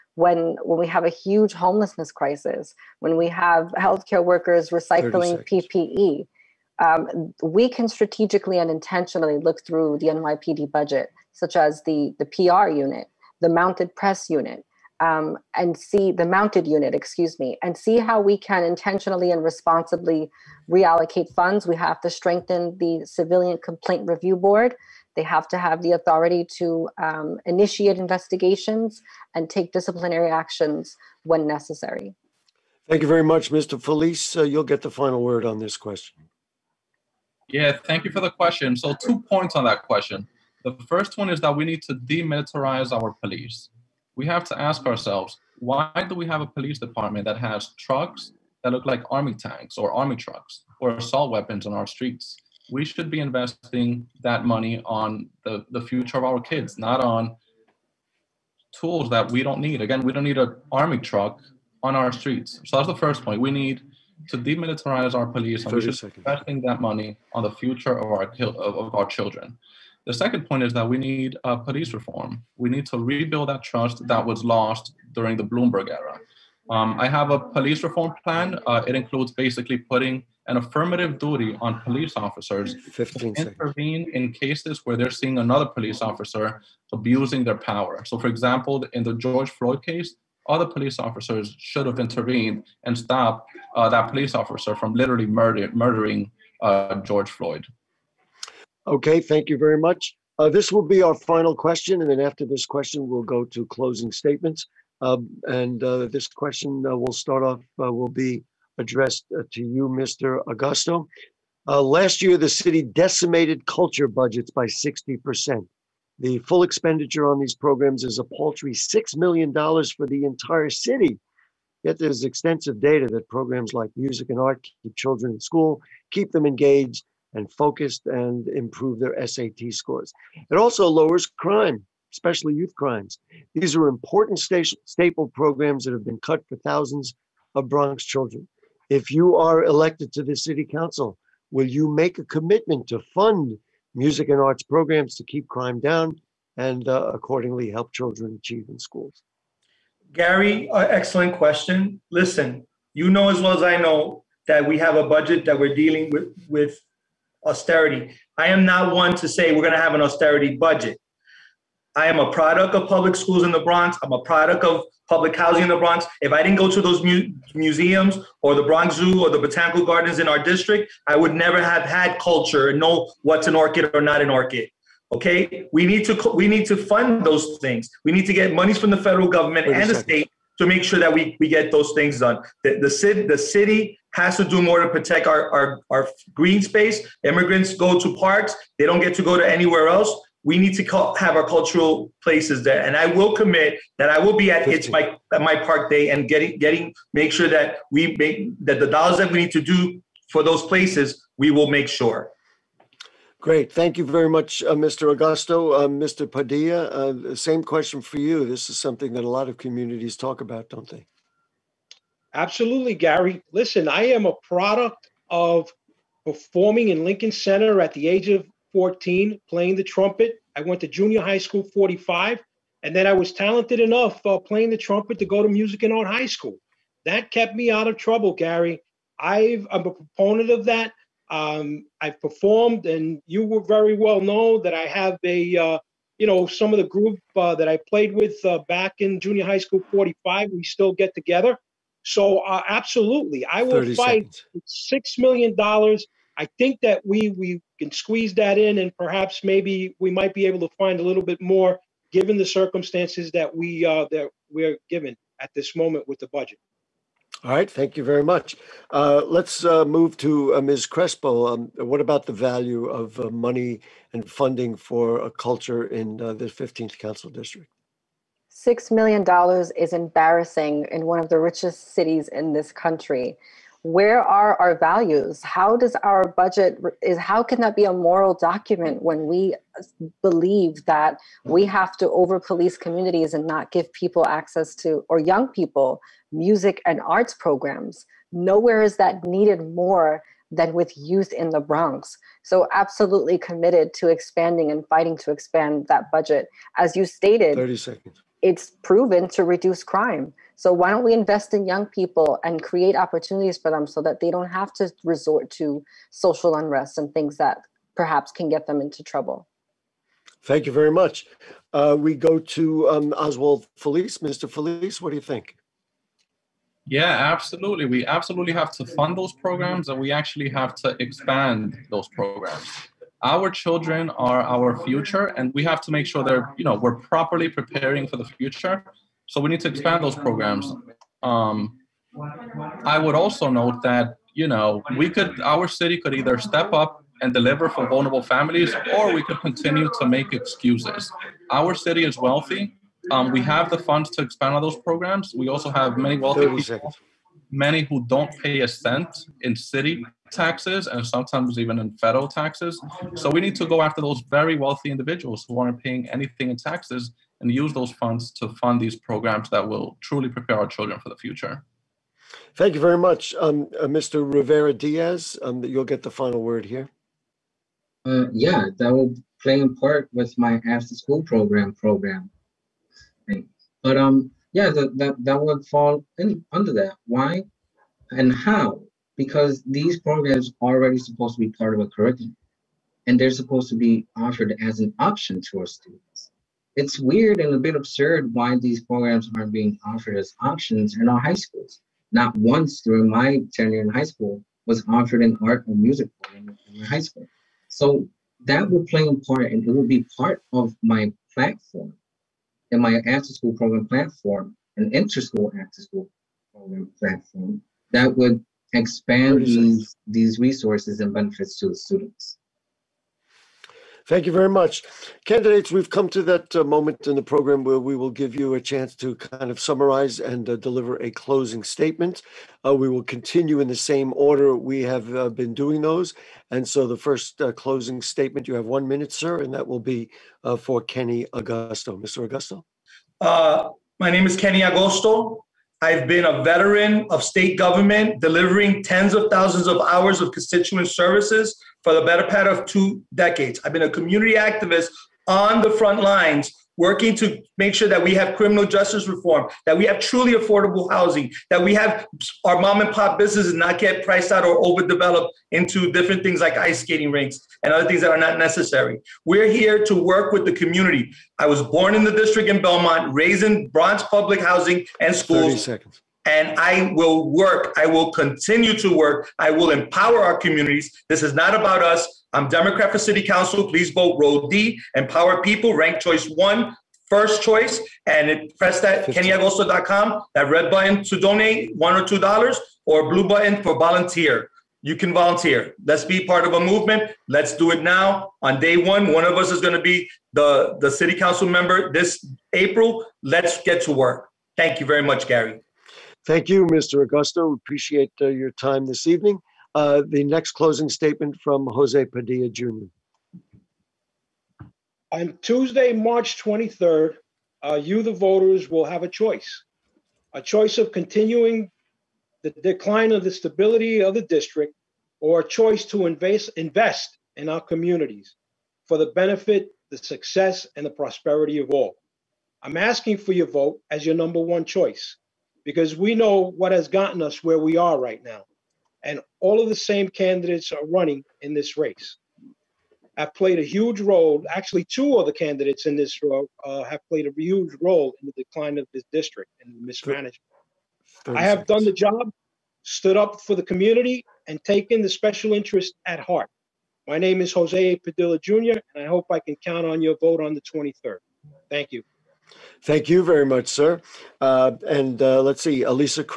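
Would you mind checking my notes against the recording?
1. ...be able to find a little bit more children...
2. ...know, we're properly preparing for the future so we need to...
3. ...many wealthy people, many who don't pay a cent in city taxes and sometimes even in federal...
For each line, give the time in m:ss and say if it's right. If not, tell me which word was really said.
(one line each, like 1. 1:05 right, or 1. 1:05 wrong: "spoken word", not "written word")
1. 4:10 wrong: "given", not "children"
2. 5:26 right
3. 5:45 right.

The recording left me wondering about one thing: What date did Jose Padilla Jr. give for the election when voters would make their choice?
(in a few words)
March 23rd.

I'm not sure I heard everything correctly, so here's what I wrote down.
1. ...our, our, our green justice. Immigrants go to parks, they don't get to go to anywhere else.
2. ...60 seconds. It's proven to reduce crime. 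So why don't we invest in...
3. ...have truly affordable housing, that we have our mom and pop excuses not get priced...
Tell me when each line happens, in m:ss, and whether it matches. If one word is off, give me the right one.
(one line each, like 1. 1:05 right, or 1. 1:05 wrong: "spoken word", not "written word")
1. 3:05 wrong: "space", not "justice"
2. 4:57 wrong: "30", not "60"
3. 7:29 wrong: "businesses", not "excuses".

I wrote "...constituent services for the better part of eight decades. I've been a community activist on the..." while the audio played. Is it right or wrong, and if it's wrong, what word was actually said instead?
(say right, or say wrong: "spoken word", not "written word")
wrong: "two", not "eight".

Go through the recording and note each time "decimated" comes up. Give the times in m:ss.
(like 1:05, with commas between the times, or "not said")
1:52.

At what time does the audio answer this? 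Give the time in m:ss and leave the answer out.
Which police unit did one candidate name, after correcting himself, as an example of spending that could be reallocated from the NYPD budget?
0:16.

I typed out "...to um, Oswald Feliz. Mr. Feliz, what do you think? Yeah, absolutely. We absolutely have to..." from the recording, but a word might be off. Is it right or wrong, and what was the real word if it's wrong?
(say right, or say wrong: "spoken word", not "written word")
right.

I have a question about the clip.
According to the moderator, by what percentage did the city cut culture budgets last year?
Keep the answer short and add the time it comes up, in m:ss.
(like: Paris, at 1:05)
60%, at 1:54.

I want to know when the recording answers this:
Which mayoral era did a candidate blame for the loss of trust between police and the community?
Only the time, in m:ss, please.
1:15.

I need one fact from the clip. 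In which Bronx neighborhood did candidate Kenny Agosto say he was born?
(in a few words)
Belmont.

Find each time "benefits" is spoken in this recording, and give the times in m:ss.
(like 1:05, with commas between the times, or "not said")
6:51, 8:39.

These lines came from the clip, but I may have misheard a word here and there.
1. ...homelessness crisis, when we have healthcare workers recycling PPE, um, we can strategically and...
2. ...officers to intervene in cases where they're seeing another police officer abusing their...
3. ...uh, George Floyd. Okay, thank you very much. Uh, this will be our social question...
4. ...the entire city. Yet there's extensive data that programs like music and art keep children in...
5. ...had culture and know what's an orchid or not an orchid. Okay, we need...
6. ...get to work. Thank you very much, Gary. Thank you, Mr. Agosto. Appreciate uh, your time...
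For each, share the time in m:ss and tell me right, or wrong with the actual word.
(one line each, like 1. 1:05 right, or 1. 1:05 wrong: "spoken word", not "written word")
1. 0:01 right
2. 1:22 right
3. 1:36 wrong: "final", not "social"
4. 2:00 right
5. 2:51 right
6. 8:13 right.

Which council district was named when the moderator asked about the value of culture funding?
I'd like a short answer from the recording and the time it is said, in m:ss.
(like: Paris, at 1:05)
15th, at 4:26.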